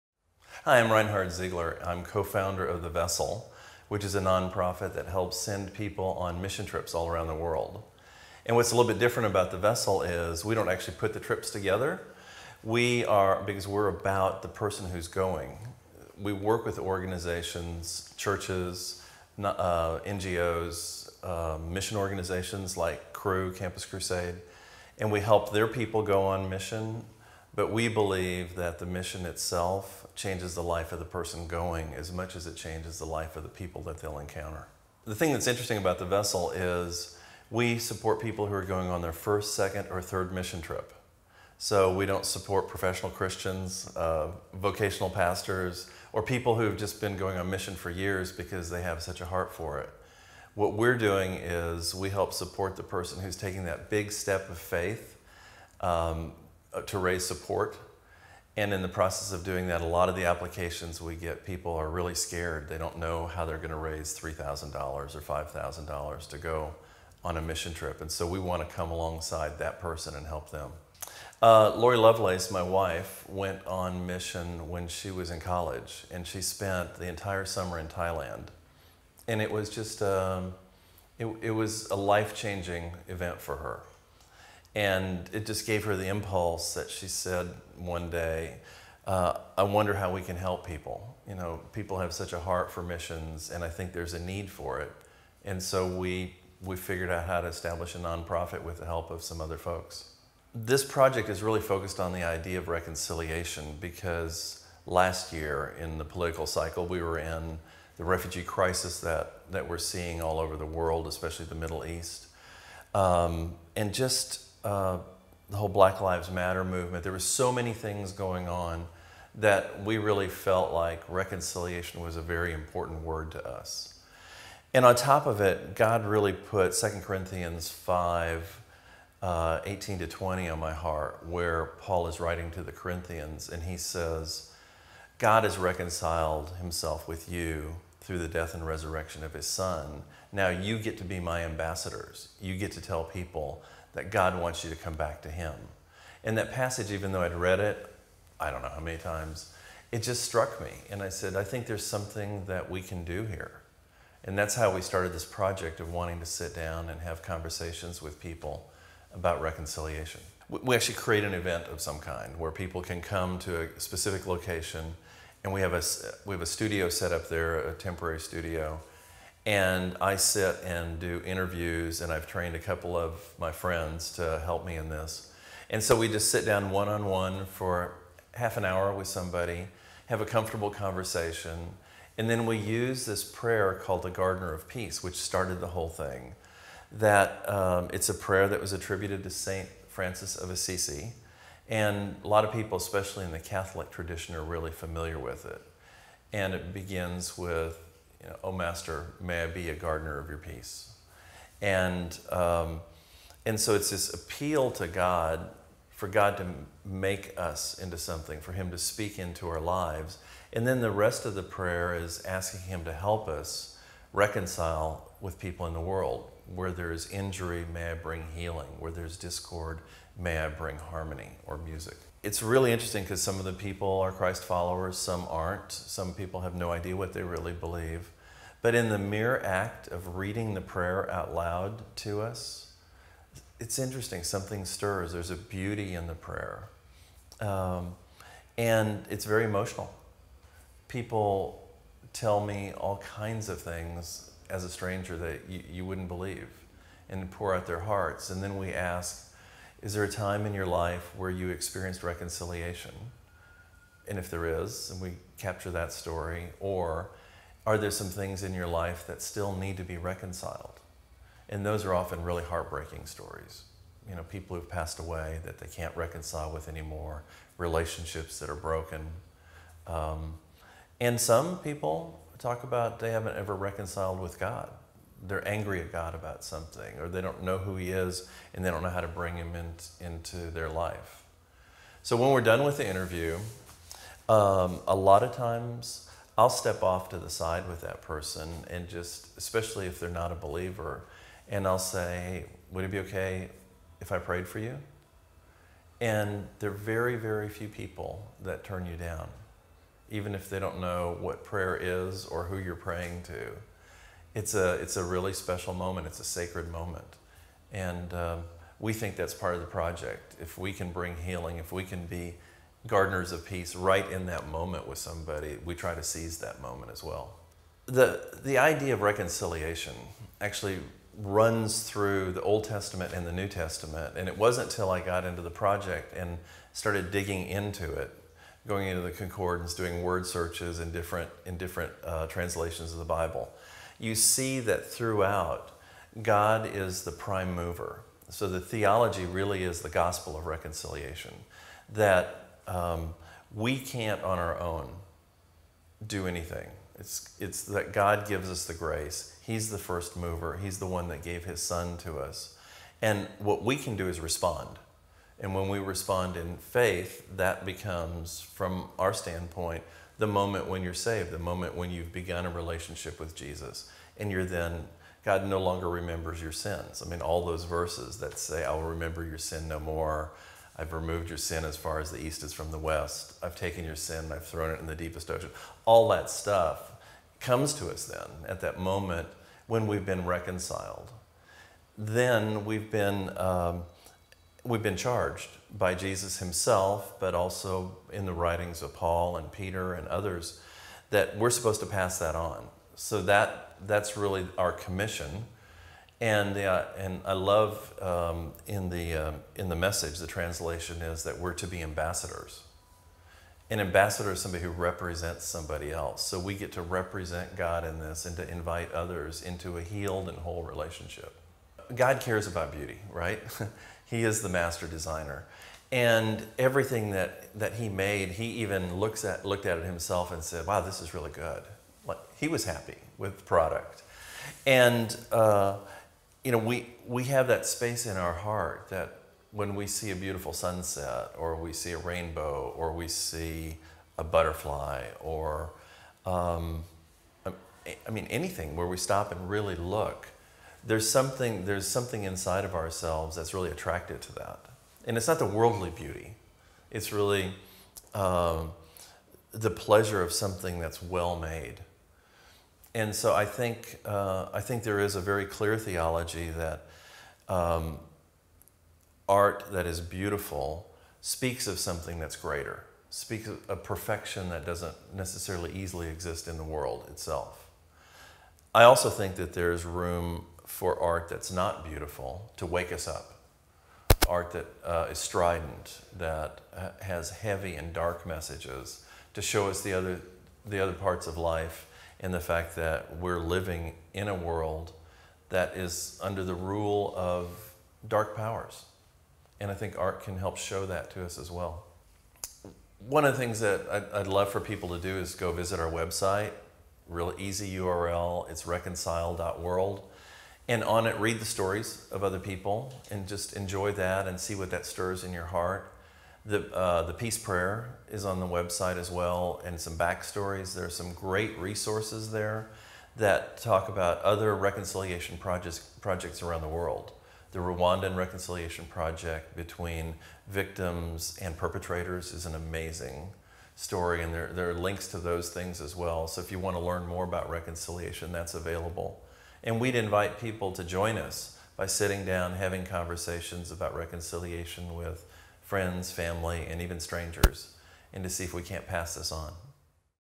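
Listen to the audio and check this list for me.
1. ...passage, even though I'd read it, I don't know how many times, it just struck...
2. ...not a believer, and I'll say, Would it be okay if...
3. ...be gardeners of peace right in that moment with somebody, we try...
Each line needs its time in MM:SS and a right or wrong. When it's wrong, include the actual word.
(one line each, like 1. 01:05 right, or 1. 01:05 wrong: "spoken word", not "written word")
1. 02:26 right
2. 04:50 right
3. 05:12 right.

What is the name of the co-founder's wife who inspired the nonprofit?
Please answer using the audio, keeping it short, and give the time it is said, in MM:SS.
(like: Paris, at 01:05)
Lori Lovelace, at 01:11.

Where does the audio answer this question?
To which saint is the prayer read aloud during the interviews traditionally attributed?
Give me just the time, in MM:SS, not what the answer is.
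03:09.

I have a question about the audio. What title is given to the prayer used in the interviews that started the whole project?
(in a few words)
Gardener of Peace.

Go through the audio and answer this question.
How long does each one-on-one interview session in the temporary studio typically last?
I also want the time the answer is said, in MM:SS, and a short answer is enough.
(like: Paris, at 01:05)
Half an hour, at 02:58.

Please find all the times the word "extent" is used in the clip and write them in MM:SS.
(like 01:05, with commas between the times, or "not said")
not said.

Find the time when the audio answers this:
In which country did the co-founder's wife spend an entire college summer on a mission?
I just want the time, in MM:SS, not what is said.
01:17.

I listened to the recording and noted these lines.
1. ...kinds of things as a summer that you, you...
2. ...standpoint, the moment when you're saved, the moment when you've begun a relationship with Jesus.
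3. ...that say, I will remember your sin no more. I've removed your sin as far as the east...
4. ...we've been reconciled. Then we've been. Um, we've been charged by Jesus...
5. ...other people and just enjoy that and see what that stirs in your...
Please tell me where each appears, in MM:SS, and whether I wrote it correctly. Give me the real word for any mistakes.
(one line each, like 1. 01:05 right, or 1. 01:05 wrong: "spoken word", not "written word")
1. 04:02 wrong: "stranger", not "summer"
2. 05:59 right
3. 06:08 right
4. 06:19 right
5. 08:22 right.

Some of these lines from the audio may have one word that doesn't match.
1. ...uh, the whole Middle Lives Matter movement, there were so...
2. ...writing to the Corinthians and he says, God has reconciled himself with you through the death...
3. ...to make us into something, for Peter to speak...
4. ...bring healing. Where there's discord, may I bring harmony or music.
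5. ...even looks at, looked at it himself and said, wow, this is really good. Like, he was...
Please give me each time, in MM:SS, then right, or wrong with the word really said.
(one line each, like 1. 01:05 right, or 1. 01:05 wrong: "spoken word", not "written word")
1. 01:54 wrong: "Black", not "Middle"
2. 02:12 right
3. 03:26 wrong: "Him", not "Peter"
4. 03:37 right
5. 06:58 right.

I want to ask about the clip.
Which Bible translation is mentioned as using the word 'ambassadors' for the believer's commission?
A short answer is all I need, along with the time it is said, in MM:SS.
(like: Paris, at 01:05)
The Message, at 06:39.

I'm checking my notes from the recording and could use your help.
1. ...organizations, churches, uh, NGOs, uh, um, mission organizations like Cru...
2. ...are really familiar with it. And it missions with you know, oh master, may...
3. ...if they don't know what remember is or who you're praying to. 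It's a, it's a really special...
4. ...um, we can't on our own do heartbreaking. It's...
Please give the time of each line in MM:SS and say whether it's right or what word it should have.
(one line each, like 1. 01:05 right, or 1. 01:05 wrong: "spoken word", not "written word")
1. 00:16 right
2. 03:14 wrong: "begins", not "missions"
3. 05:00 wrong: "prayer", not "remember"
4. 05:42 wrong: "anything", not "heartbreaking".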